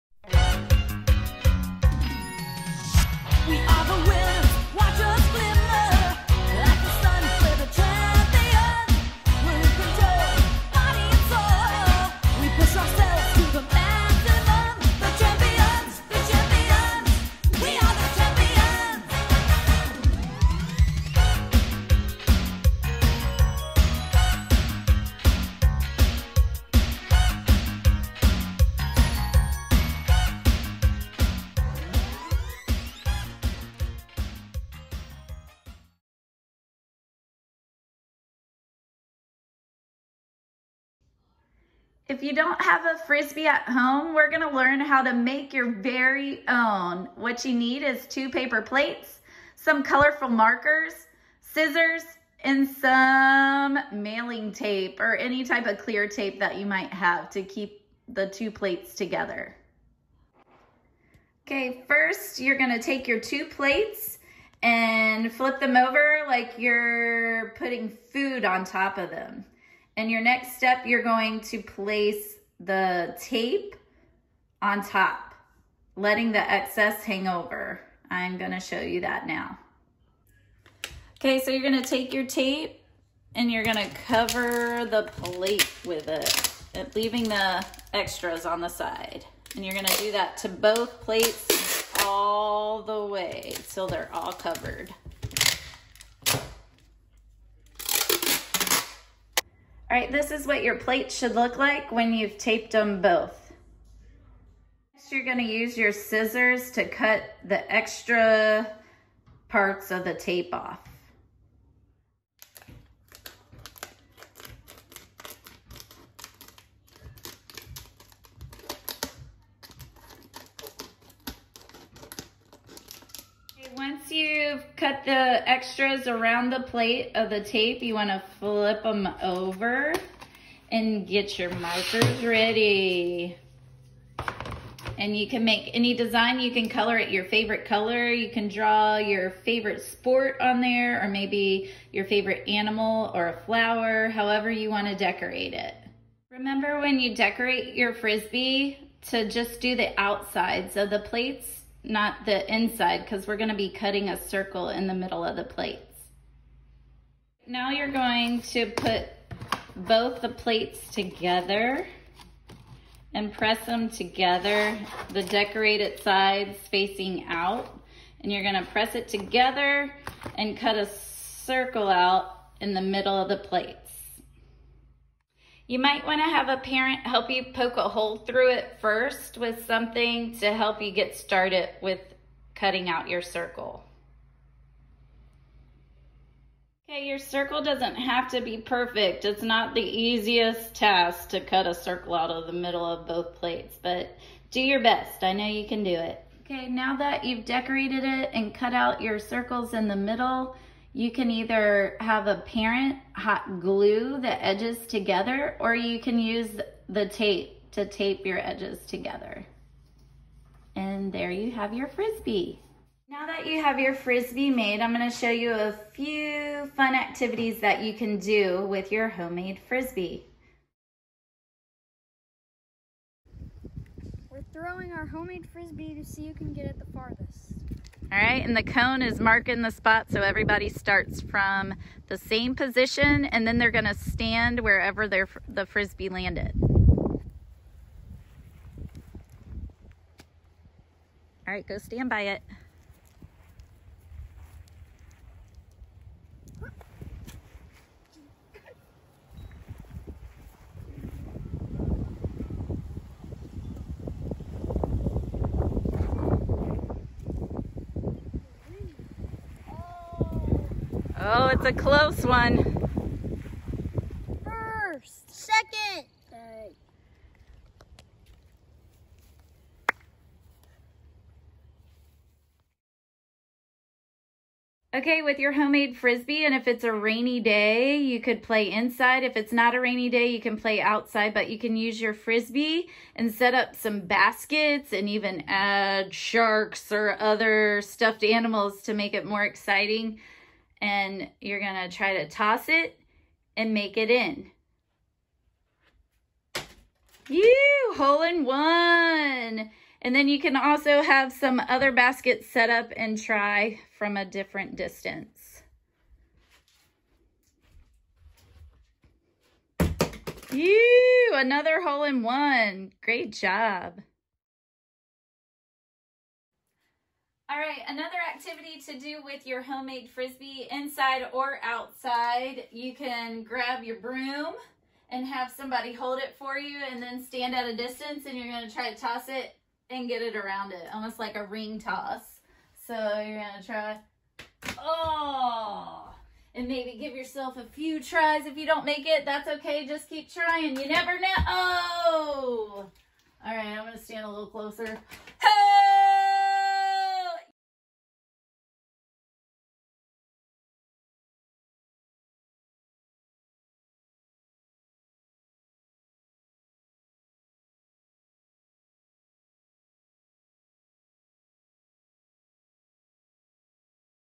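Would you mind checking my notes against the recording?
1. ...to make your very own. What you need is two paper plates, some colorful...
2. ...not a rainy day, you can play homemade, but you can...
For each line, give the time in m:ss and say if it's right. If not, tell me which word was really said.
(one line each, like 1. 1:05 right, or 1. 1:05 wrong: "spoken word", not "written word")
1. 0:45 right
2. 4:39 wrong: "outside", not "homemade".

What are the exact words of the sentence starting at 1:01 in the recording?
Okay, first you're gonna take your two plates and flip them over like you're putting food on top of them.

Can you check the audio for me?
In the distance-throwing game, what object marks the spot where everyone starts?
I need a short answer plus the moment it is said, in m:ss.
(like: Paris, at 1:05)
the cone, at 3:48.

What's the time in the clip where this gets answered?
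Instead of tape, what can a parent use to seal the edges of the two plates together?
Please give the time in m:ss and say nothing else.
3:23.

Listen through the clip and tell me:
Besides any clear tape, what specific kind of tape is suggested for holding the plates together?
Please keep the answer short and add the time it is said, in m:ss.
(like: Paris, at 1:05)
mailing tape, at 0:53.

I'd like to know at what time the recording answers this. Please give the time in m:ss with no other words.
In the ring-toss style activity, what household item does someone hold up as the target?
5:23.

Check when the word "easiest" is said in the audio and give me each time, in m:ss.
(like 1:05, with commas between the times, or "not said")
3:09.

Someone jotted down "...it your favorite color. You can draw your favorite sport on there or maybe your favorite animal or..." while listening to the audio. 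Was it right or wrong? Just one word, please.
right.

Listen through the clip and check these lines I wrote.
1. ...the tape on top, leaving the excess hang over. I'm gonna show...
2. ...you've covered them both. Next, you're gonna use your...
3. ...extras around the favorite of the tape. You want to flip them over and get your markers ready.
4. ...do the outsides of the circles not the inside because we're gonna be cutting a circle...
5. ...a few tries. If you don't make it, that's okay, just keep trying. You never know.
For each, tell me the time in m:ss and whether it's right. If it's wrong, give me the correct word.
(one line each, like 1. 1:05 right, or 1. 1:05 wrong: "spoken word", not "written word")
1. 1:12 wrong: "letting", not "leaving"
2. 1:42 wrong: "taped", not "covered"
3. 2:05 wrong: "plate", not "favorite"
4. 2:29 wrong: "plates", not "circles"
5. 5:37 right.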